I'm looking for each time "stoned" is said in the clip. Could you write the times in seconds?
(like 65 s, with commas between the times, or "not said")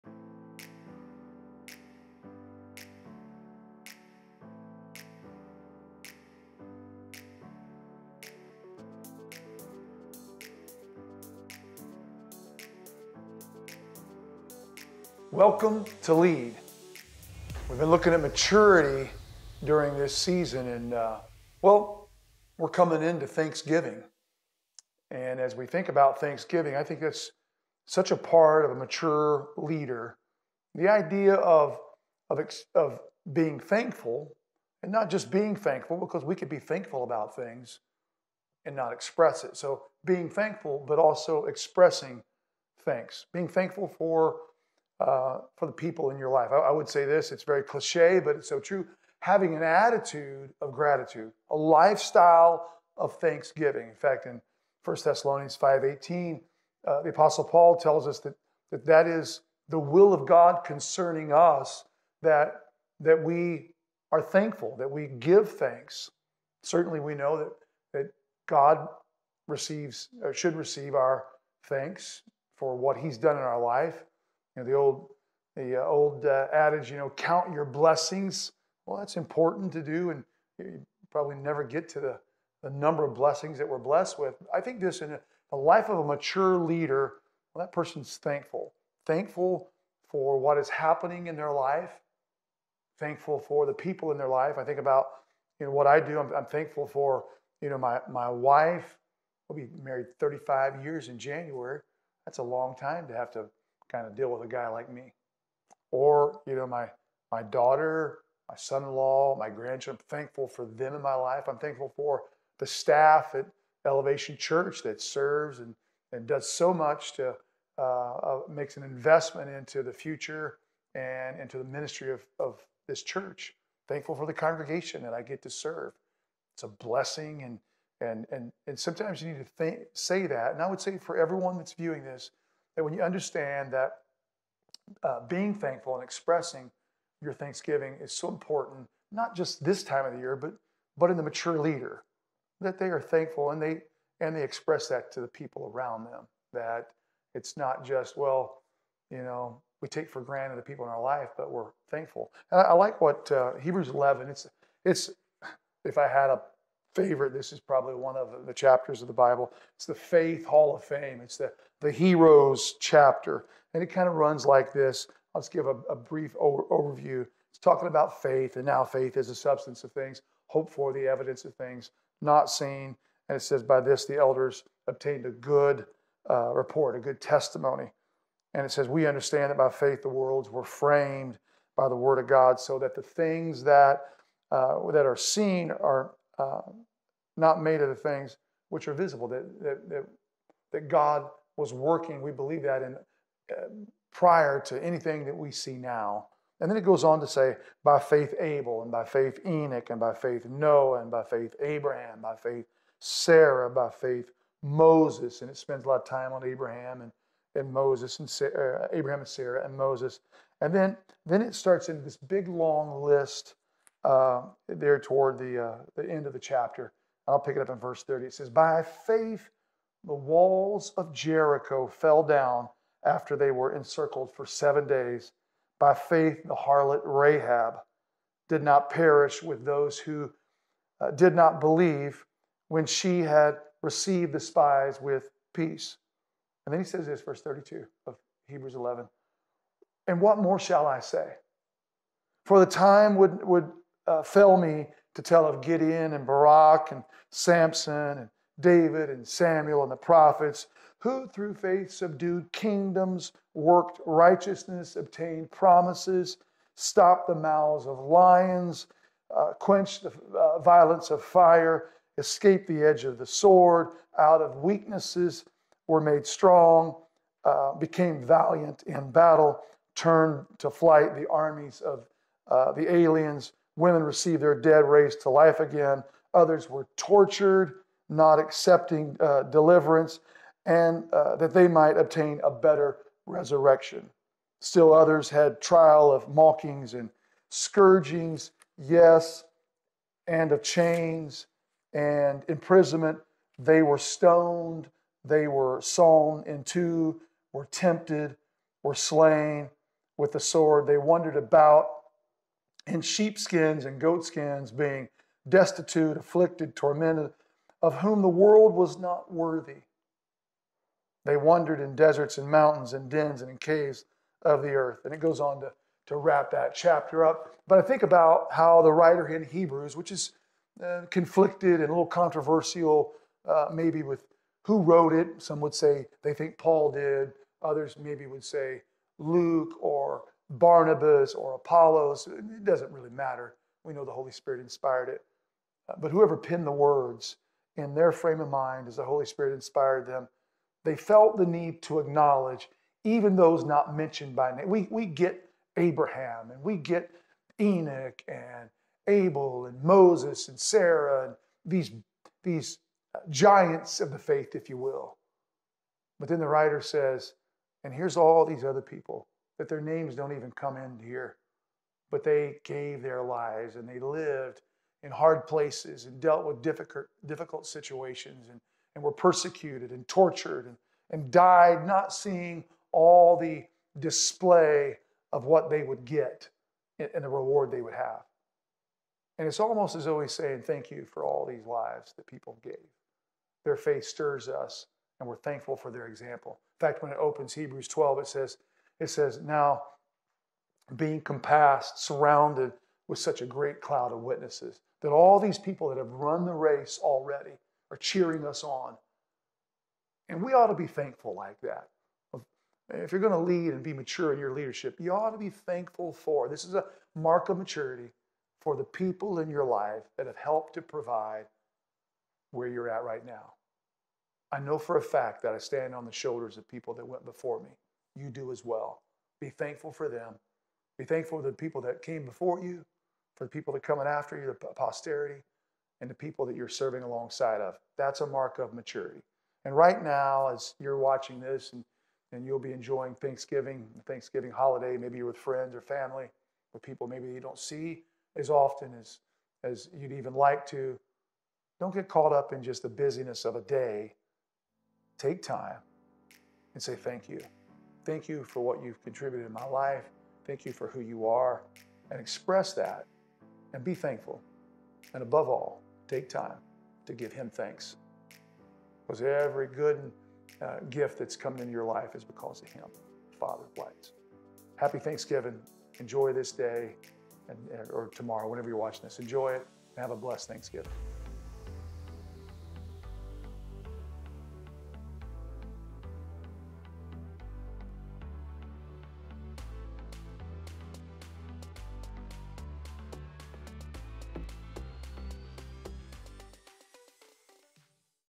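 293 s.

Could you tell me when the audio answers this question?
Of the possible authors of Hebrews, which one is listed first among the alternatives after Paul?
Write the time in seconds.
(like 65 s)
329 s.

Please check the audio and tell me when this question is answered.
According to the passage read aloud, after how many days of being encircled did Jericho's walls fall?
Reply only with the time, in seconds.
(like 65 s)
224 s.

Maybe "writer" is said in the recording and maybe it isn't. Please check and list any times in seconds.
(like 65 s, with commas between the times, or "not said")
318 s, 356 s.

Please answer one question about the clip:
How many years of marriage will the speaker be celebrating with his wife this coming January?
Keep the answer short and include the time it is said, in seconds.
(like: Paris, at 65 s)
35, at 100 s.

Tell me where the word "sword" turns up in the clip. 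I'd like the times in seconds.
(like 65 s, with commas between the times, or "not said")
263 s, 300 s.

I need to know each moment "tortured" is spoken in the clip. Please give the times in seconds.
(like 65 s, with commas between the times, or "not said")
276 s, 370 s.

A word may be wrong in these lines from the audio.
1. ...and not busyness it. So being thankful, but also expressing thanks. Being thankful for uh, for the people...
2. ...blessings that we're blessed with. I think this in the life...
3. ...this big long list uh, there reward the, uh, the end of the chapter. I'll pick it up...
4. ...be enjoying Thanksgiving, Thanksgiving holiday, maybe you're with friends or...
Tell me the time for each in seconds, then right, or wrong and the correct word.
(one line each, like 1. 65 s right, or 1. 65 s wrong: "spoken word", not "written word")
1. 38 s wrong: "express", not "busyness"
2. 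83 s right
3. 212 s wrong: "toward", not "reward"
4. 432 s right.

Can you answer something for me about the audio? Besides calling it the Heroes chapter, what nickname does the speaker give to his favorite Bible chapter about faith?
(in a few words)
Faith Hall of Fame.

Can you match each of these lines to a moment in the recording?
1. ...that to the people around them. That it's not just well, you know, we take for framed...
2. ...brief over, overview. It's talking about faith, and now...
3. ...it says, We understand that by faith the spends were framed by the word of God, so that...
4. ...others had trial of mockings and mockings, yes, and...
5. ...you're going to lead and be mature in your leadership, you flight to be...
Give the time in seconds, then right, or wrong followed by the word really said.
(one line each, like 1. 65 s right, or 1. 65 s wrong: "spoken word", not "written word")
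1. 144 s wrong: "granted", not "framed"
2. 165 s right
3. 178 s wrong: "worlds", not "spends"
4. 284 s wrong: "scourgings", not "mockings"
5. 403 s wrong: "ought", not "flight".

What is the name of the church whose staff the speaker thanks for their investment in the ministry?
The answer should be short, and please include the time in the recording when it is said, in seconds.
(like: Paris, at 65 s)
Elevation Church, at 113 s.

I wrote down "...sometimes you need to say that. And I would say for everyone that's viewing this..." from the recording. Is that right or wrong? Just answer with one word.
right.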